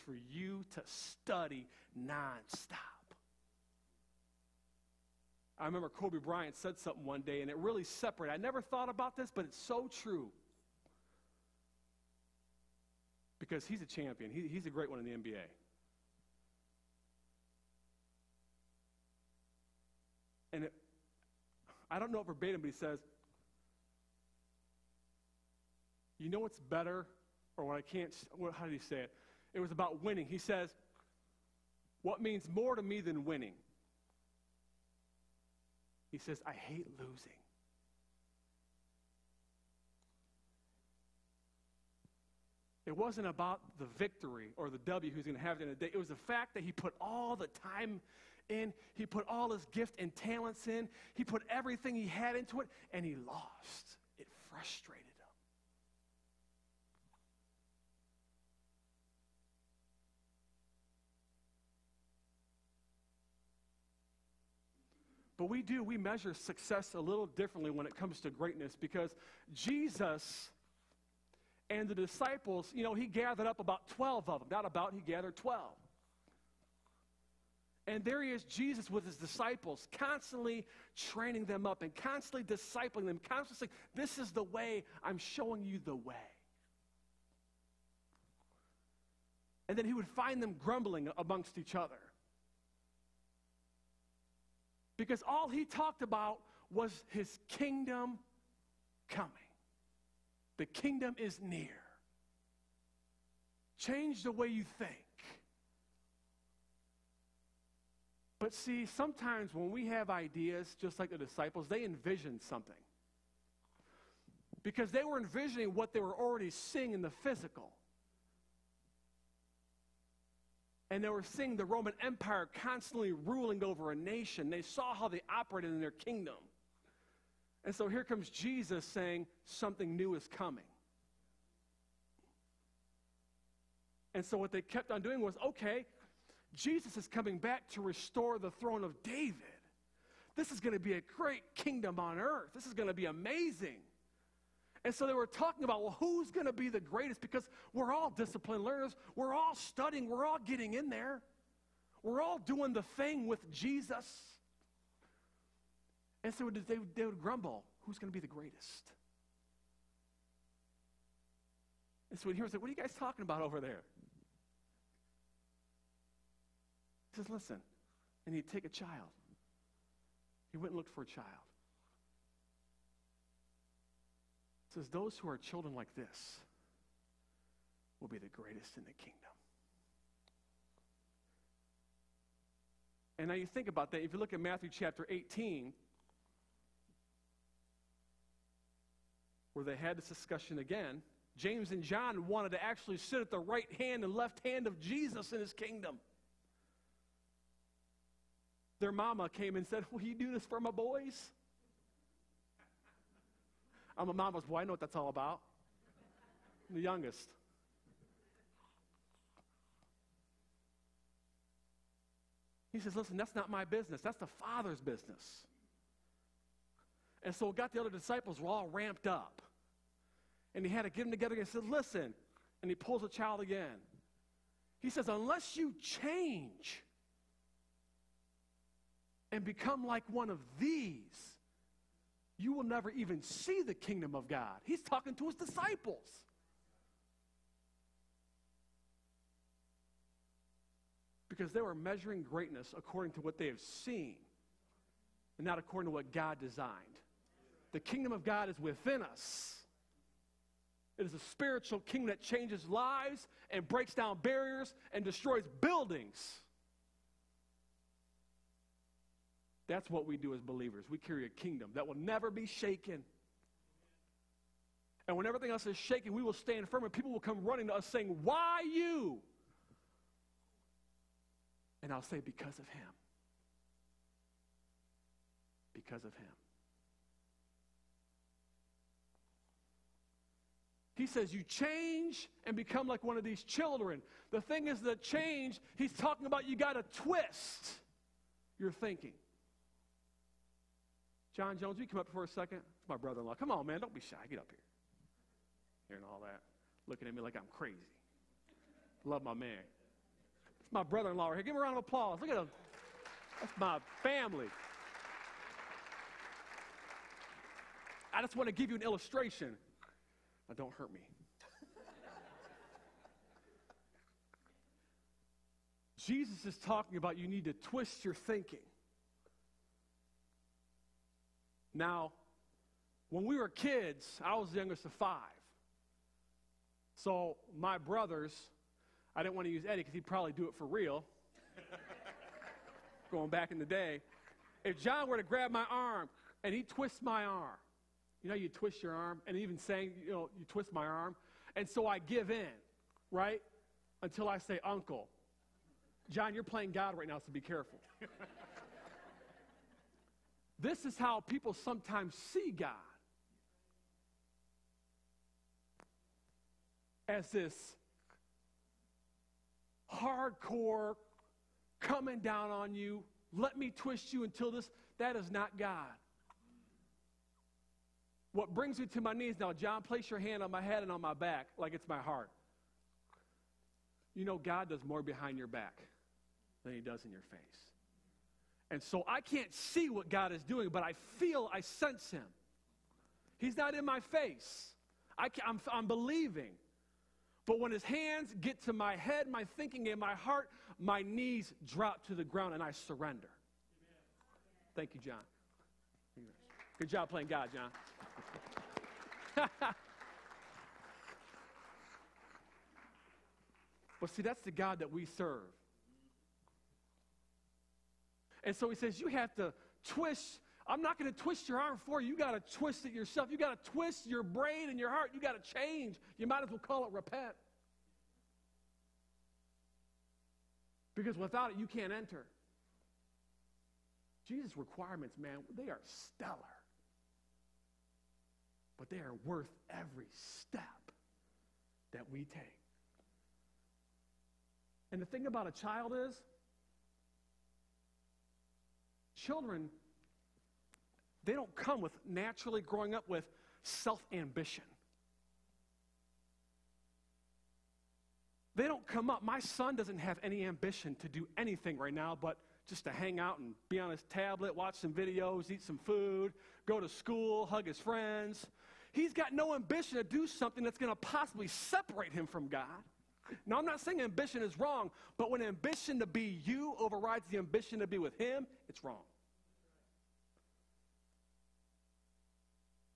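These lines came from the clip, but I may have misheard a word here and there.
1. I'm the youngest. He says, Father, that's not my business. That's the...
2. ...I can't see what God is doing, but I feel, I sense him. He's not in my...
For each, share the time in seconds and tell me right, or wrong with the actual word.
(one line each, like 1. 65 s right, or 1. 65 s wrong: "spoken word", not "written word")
1. 206 s wrong: "Listen", not "Father"
2. 379 s right.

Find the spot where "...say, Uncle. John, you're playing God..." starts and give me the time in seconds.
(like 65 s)
344 s.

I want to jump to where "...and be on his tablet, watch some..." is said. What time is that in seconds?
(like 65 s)
453 s.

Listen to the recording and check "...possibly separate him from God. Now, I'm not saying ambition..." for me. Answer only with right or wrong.
right.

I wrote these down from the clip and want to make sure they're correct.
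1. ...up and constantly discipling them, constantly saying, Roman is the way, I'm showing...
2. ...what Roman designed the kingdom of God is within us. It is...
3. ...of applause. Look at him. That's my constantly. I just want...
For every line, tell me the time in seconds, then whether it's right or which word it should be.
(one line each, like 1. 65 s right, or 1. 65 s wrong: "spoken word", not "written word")
1. 81 s wrong: "This", not "Roman"
2. 245 s wrong: "God", not "Roman"
3. 301 s wrong: "family", not "constantly".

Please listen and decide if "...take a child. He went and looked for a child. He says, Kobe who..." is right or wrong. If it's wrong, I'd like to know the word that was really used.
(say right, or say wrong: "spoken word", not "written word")
wrong: "Those", not "Kobe".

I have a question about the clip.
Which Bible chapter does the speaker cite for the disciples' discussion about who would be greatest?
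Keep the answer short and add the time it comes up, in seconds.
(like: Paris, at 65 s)
Matthew 18, at 184 s.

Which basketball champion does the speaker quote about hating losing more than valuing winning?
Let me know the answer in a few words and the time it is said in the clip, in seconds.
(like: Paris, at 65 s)
Kobe Bryant, at 5 s.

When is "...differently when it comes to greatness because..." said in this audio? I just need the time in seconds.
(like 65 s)
67 s.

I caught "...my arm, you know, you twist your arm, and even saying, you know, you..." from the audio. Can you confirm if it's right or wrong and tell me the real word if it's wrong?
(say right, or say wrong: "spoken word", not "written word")
right.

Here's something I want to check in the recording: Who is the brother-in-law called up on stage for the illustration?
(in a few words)
John Jones.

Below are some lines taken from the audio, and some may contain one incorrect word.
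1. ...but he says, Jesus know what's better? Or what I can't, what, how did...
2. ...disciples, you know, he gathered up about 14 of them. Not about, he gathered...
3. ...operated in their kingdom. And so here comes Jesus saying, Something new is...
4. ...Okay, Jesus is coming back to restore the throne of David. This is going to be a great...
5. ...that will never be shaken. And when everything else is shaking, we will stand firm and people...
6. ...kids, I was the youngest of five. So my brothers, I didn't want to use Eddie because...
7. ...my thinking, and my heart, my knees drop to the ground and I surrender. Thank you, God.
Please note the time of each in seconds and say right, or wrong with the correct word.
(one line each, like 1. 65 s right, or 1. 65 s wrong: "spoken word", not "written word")
1. 22 s wrong: "You", not "Jesus"
2. 71 s wrong: "12", not "14"
3. 125 s right
4. 135 s right
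5. 261 s right
6. 323 s right
7. 389 s wrong: "John", not "God".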